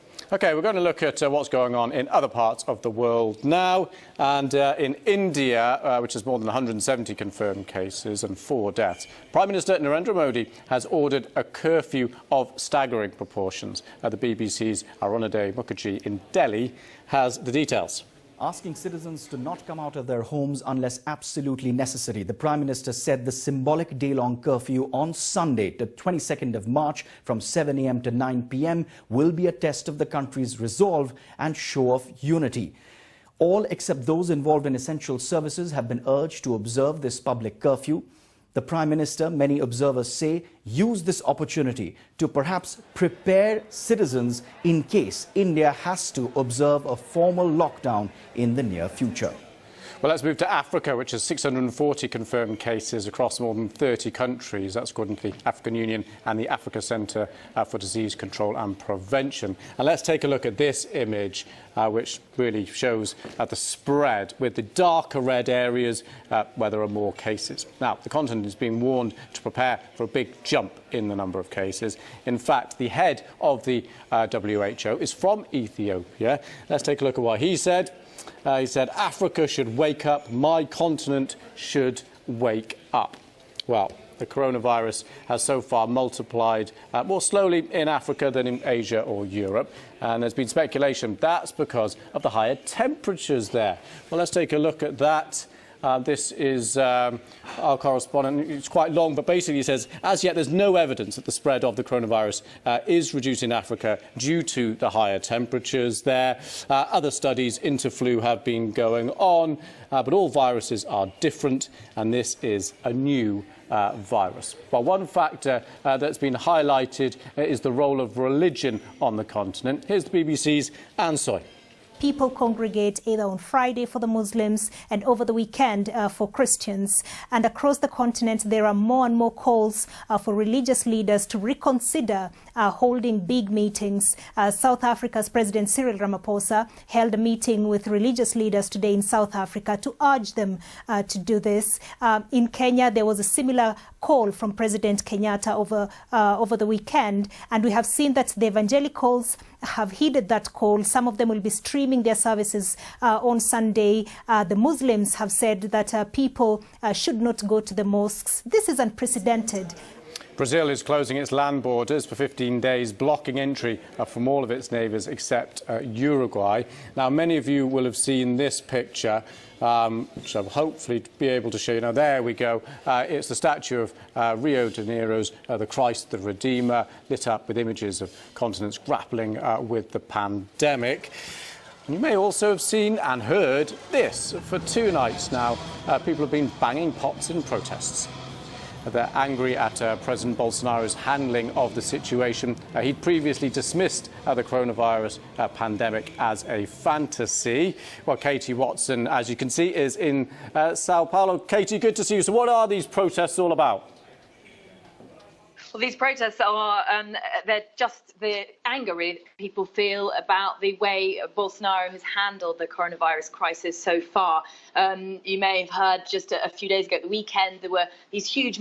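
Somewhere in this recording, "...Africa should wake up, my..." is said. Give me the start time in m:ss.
1:18.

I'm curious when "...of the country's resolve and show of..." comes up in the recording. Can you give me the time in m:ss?
0:29.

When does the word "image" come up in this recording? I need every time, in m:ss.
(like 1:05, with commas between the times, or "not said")
1:00, 2:57.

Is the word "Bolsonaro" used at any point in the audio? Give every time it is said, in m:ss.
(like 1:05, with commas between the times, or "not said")
3:10, 3:31.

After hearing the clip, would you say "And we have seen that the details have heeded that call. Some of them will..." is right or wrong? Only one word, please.
wrong.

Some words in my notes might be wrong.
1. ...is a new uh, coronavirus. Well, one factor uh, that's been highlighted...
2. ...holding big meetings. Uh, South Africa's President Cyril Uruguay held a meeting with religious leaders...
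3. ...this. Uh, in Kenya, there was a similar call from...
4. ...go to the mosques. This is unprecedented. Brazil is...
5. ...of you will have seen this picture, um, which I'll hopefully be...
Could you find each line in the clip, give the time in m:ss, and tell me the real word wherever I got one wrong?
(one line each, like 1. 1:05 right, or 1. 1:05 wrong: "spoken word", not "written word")
1. 1:52 wrong: "virus", not "coronavirus"
2. 2:12 wrong: "Ramaphosa", not "Uruguay"
3. 2:21 right
4. 2:37 right
5. 2:47 right.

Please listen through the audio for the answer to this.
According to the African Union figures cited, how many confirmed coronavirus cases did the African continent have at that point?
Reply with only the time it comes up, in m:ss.
0:51.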